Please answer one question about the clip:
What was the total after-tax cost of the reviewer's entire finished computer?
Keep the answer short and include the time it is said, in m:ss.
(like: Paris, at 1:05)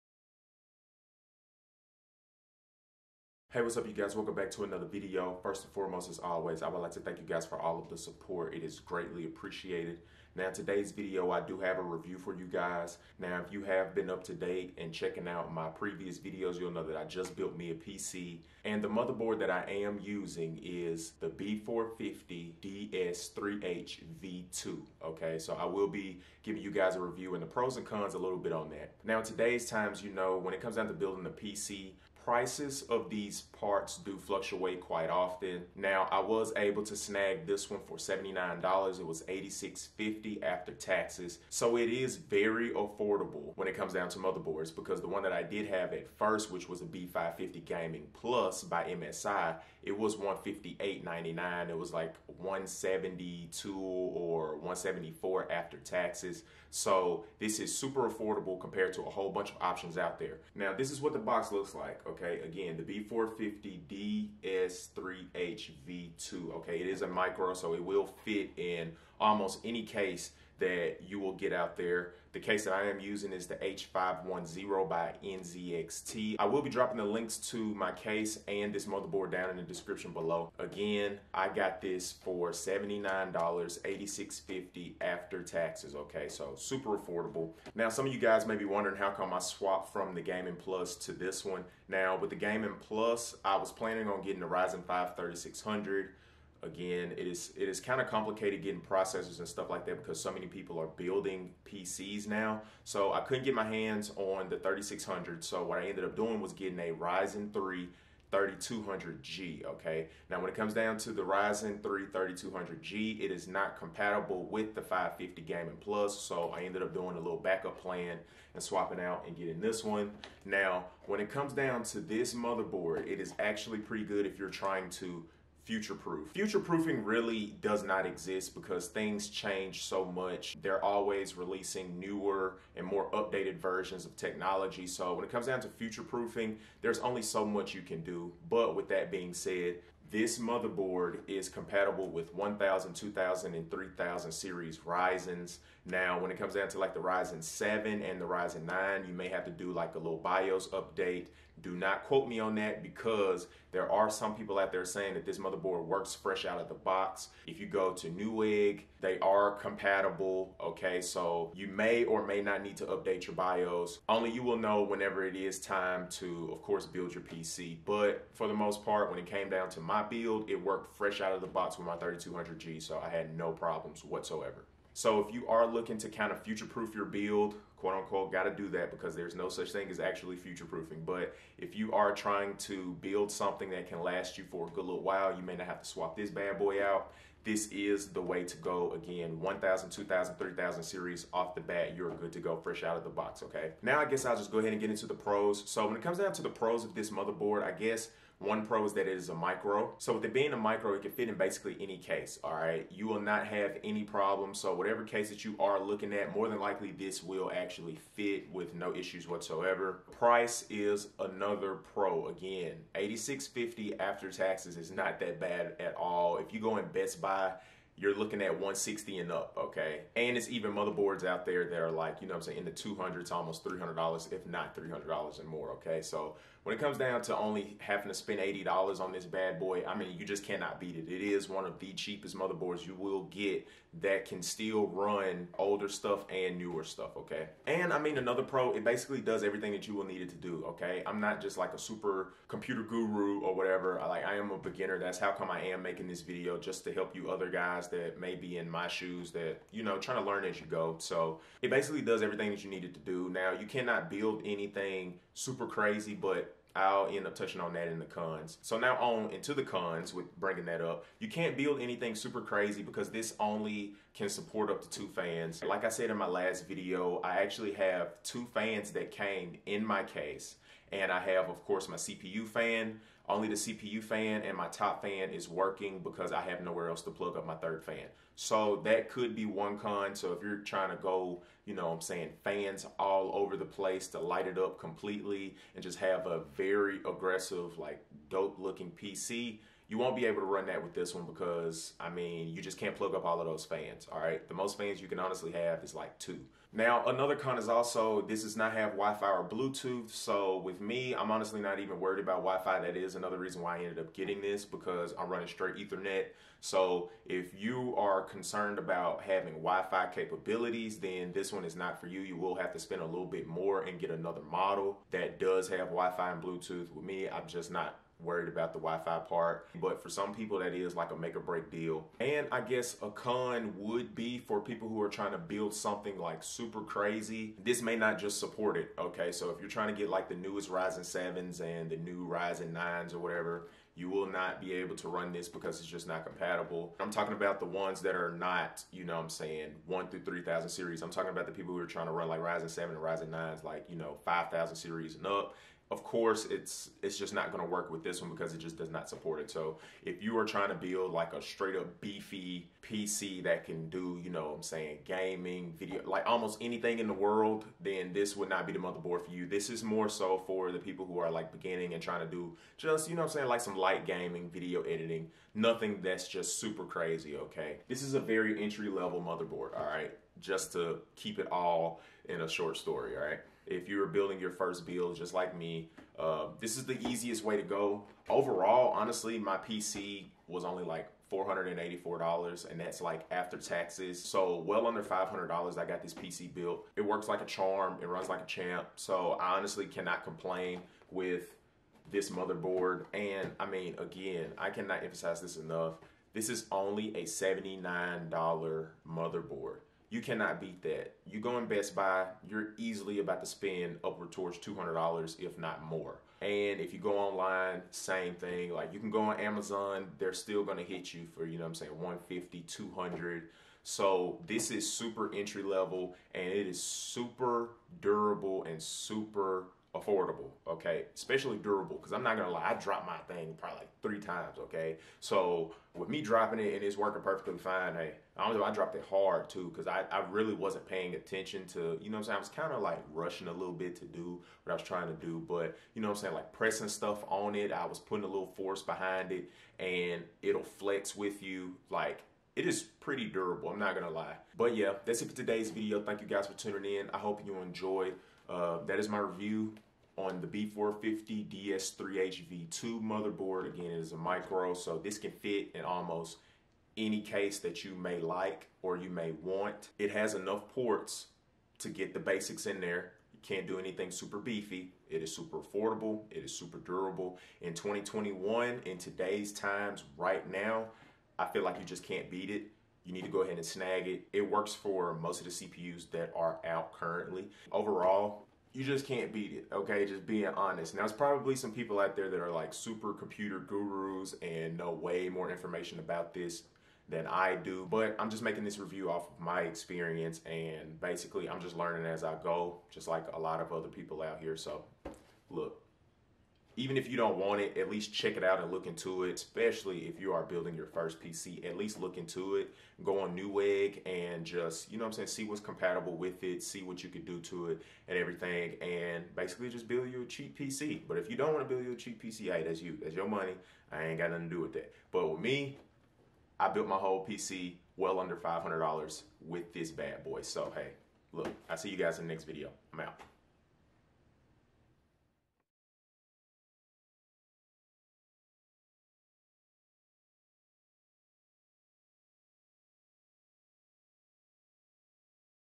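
$484, at 6:21.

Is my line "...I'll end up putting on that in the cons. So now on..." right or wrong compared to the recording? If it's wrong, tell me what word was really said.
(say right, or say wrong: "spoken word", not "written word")
wrong: "touching", not "putting".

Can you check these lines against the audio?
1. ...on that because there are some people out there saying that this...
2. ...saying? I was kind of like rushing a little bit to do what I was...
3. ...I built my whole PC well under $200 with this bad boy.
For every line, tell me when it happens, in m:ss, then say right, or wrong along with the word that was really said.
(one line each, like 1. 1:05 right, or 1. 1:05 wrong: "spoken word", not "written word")
1. 2:32 right
2. 7:12 right
3. 8:36 wrong: "500", not "200".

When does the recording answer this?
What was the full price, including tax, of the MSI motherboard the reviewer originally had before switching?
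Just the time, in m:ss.
0:50.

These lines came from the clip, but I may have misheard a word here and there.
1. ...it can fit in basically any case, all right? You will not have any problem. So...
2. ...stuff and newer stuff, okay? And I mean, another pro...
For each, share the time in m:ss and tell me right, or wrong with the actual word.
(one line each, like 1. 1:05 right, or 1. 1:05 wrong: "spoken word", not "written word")
1. 3:20 right
2. 3:55 right.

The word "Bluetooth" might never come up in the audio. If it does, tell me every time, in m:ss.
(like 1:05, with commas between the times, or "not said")
4:59, 5:16.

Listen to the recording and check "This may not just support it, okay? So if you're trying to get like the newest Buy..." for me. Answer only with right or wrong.
wrong.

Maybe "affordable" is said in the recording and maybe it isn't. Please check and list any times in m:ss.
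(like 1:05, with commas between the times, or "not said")
0:42, 0:58, 1:26, 7:00, 7:45.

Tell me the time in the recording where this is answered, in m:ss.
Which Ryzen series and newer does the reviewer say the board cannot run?
5:44.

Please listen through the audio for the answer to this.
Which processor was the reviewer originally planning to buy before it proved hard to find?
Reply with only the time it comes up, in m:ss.
1:34.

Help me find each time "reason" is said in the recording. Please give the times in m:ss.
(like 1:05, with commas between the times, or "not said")
5:03.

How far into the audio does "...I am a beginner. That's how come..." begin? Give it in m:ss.
4:04.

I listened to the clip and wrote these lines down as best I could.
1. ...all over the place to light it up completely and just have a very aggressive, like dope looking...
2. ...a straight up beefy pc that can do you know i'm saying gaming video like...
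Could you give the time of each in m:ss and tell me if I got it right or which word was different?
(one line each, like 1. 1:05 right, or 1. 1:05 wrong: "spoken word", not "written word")
1. 4:42 right
2. 5:51 right.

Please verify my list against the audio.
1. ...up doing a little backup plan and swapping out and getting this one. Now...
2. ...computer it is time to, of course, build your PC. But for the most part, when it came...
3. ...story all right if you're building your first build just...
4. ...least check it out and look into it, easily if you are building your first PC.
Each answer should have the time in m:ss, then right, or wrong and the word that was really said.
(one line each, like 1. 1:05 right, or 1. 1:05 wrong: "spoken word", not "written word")
1. 1:56 right
2. 2:44 wrong: "whenever", not "computer"
3. 6:12 right
4. 8:17 wrong: "especially", not "easily".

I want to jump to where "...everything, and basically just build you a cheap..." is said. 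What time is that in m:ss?
8:28.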